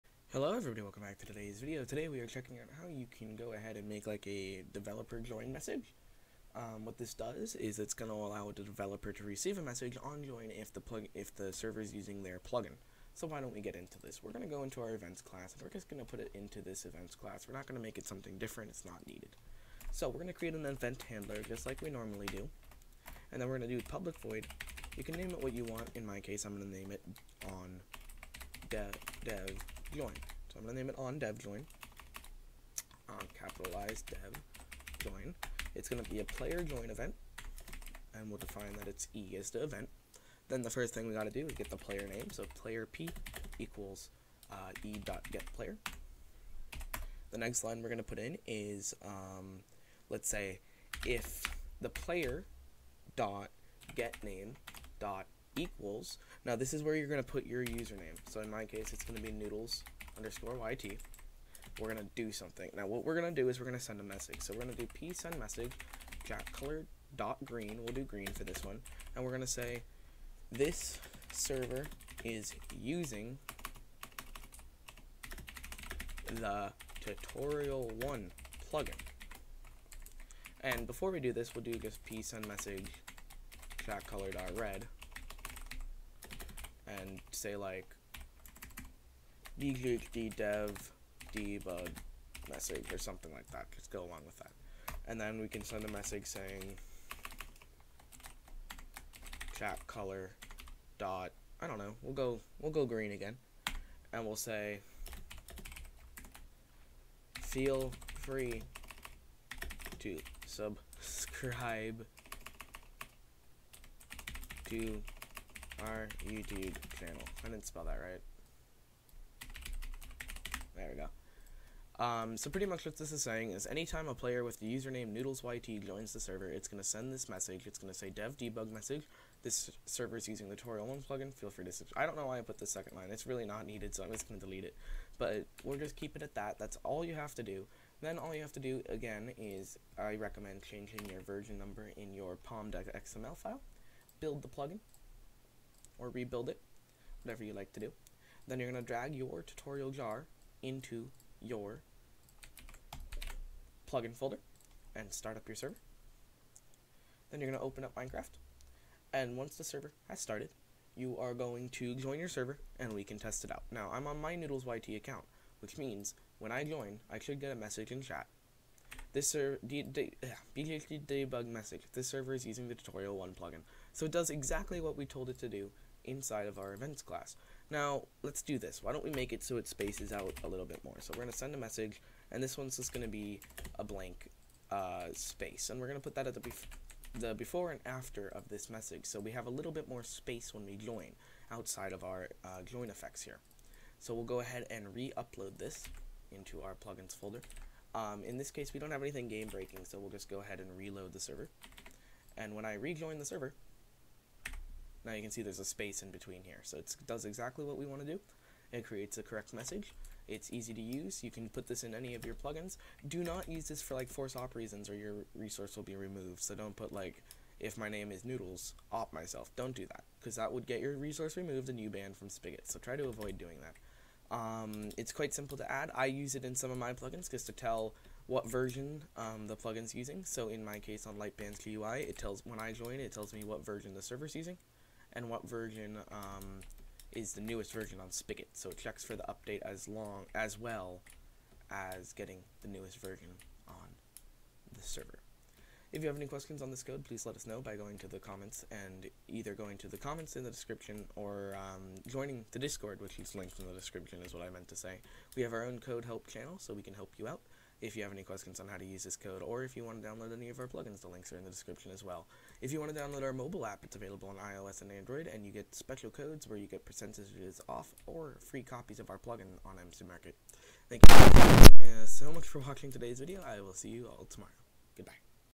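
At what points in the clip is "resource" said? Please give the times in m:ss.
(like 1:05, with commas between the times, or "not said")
3:35, 3:40.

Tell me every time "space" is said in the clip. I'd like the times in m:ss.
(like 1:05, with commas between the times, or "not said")
2:59, 3:05, 3:10, 3:25.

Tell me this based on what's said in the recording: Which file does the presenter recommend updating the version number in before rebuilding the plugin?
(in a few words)
POM.xml.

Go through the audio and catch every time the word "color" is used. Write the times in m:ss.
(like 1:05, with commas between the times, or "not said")
1:06, 1:24, 1:39.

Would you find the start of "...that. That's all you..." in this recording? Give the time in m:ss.
2:16.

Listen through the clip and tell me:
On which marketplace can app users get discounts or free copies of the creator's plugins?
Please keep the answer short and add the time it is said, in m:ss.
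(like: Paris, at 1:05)
MC Market, at 4:29.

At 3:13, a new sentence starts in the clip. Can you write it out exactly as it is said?
So we'll go ahead and re-upload this into our plugins folder.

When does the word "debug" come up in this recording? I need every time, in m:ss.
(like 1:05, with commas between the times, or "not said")
1:31, 2:08, 2:49.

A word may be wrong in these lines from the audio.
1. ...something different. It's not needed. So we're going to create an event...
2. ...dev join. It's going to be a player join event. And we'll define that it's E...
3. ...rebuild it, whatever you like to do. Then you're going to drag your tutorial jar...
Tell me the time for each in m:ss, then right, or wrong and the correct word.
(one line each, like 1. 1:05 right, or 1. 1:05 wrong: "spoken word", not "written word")
1. 0:18 right
2. 0:34 right
3. 2:26 right.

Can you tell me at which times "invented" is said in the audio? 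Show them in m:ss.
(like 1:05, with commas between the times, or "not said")
not said.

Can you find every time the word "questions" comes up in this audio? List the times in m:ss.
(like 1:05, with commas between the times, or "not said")
4:06, 4:18.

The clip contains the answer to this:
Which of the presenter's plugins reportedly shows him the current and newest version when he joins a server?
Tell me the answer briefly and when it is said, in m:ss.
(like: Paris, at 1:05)
Lightband's GUI, at 3:51.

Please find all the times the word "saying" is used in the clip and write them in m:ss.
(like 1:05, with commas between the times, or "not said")
1:36, 2:03.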